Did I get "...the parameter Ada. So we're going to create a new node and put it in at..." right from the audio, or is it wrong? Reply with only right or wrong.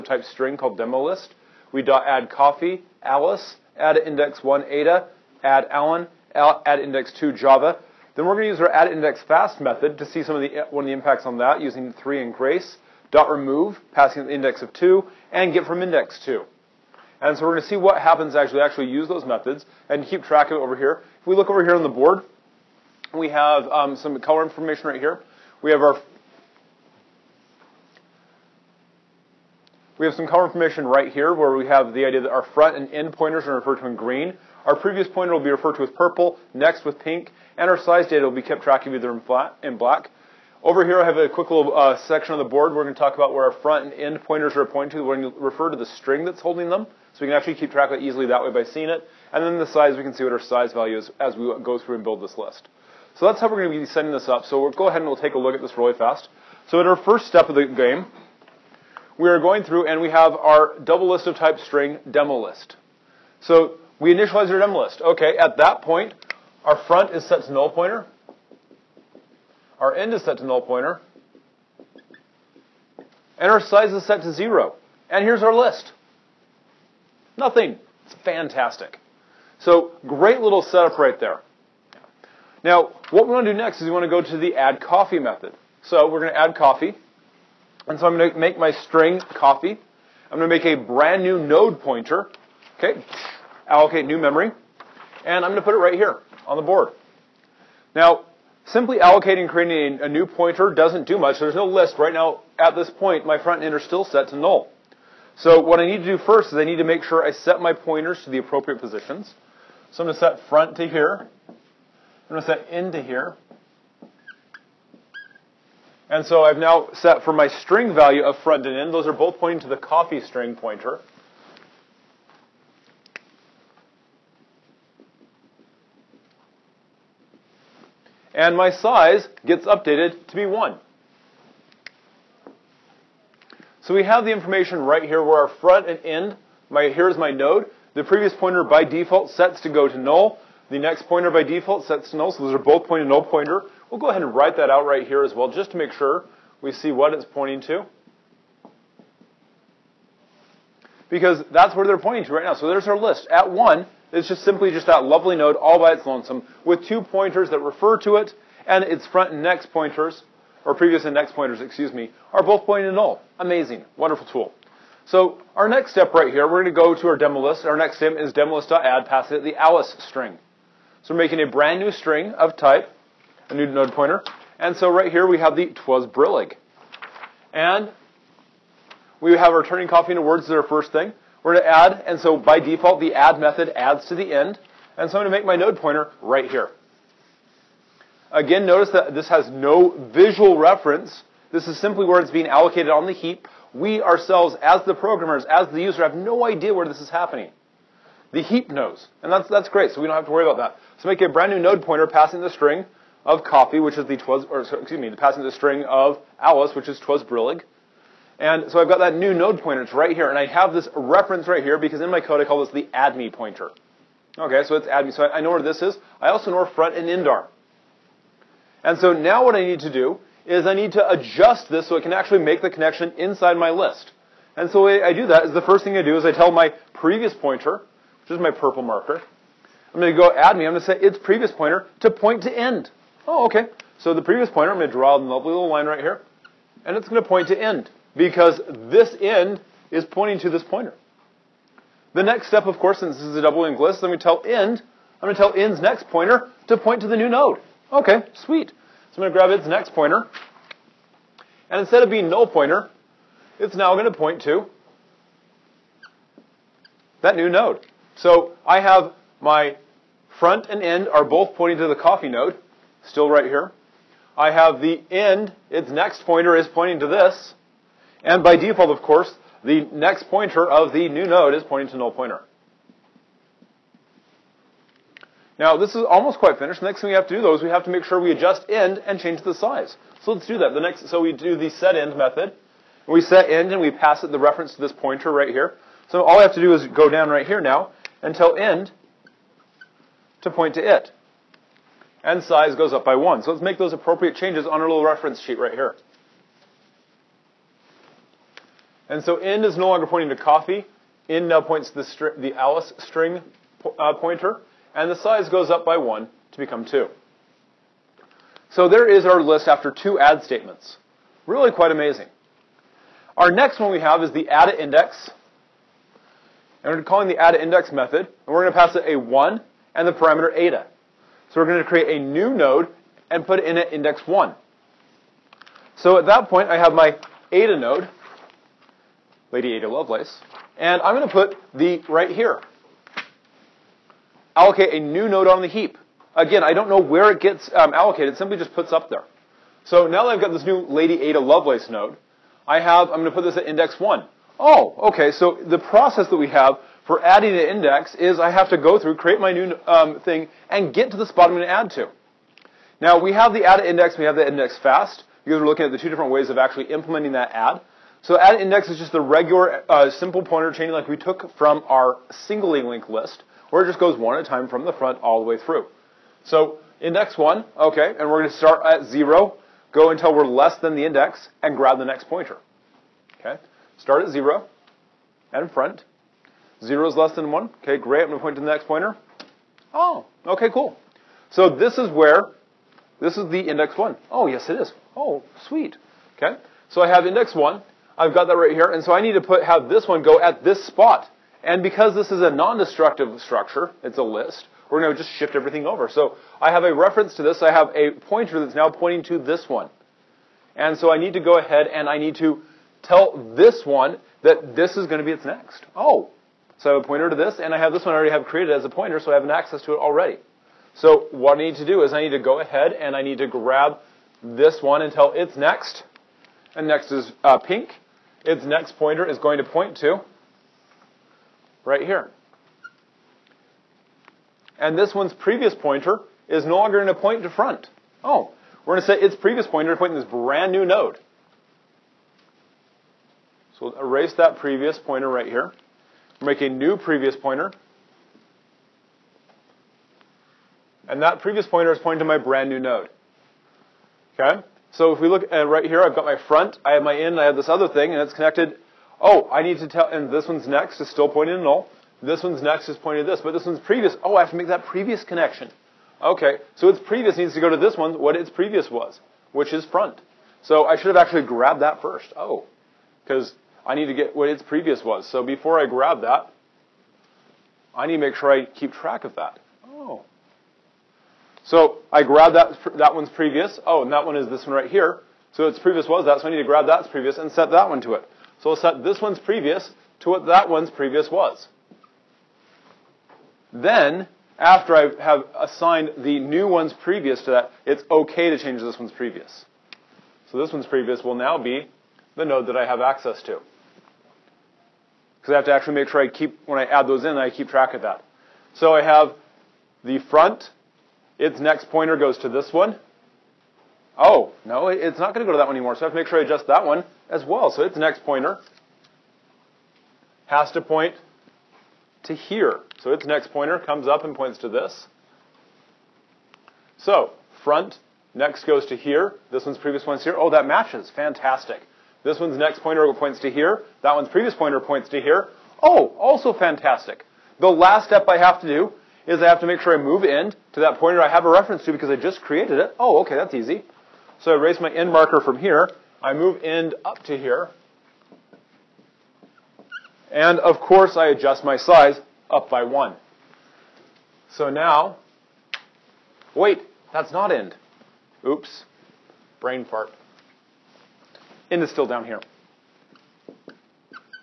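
right.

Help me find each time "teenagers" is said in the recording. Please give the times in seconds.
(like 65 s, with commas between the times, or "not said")
not said.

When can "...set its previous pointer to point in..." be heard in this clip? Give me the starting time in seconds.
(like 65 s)
429 s.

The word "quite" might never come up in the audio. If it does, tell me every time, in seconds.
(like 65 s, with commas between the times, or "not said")
276 s, 311 s.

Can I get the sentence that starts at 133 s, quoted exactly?
So we have the information right here where our front and end, my, here's my node.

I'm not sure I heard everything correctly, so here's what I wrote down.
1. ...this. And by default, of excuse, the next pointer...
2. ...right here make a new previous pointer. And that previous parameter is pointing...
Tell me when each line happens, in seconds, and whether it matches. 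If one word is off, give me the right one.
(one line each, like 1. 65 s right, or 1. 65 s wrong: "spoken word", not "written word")
1. 267 s wrong: "course", not "excuse"
2. 435 s wrong: "pointer", not "parameter".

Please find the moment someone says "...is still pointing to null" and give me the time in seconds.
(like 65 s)
450 s.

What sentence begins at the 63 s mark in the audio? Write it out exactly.
So we initialize our demo list.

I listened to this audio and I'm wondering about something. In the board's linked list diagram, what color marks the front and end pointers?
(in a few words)
green.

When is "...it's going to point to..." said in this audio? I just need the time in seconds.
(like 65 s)
236 s.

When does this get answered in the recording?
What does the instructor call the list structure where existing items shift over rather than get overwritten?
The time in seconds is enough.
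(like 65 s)
392 s.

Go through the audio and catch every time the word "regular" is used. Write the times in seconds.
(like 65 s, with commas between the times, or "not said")
359 s.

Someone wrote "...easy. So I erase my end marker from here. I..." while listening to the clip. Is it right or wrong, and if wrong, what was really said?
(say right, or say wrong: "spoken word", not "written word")
right.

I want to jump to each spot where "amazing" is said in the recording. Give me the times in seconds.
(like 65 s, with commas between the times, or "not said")
163 s, 311 s.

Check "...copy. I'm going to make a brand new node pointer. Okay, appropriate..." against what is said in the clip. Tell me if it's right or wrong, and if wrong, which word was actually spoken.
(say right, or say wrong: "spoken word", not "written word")
wrong: "allocate", not "appropriate".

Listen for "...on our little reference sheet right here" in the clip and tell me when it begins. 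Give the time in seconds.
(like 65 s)
294 s.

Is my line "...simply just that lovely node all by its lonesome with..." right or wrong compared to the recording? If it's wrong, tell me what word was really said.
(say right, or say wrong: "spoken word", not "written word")
right.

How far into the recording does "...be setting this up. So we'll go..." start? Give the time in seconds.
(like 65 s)
53 s.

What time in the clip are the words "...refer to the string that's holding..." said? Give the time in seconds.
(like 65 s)
45 s.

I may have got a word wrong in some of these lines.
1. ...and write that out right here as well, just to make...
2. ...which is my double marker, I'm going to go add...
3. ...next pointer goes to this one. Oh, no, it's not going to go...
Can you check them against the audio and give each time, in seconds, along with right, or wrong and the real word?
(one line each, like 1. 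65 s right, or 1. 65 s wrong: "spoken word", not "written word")
1. 144 s right
2. 228 s wrong: "purple", not "double"
3. 501 s right.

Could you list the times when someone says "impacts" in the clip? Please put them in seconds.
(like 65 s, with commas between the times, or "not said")
10 s.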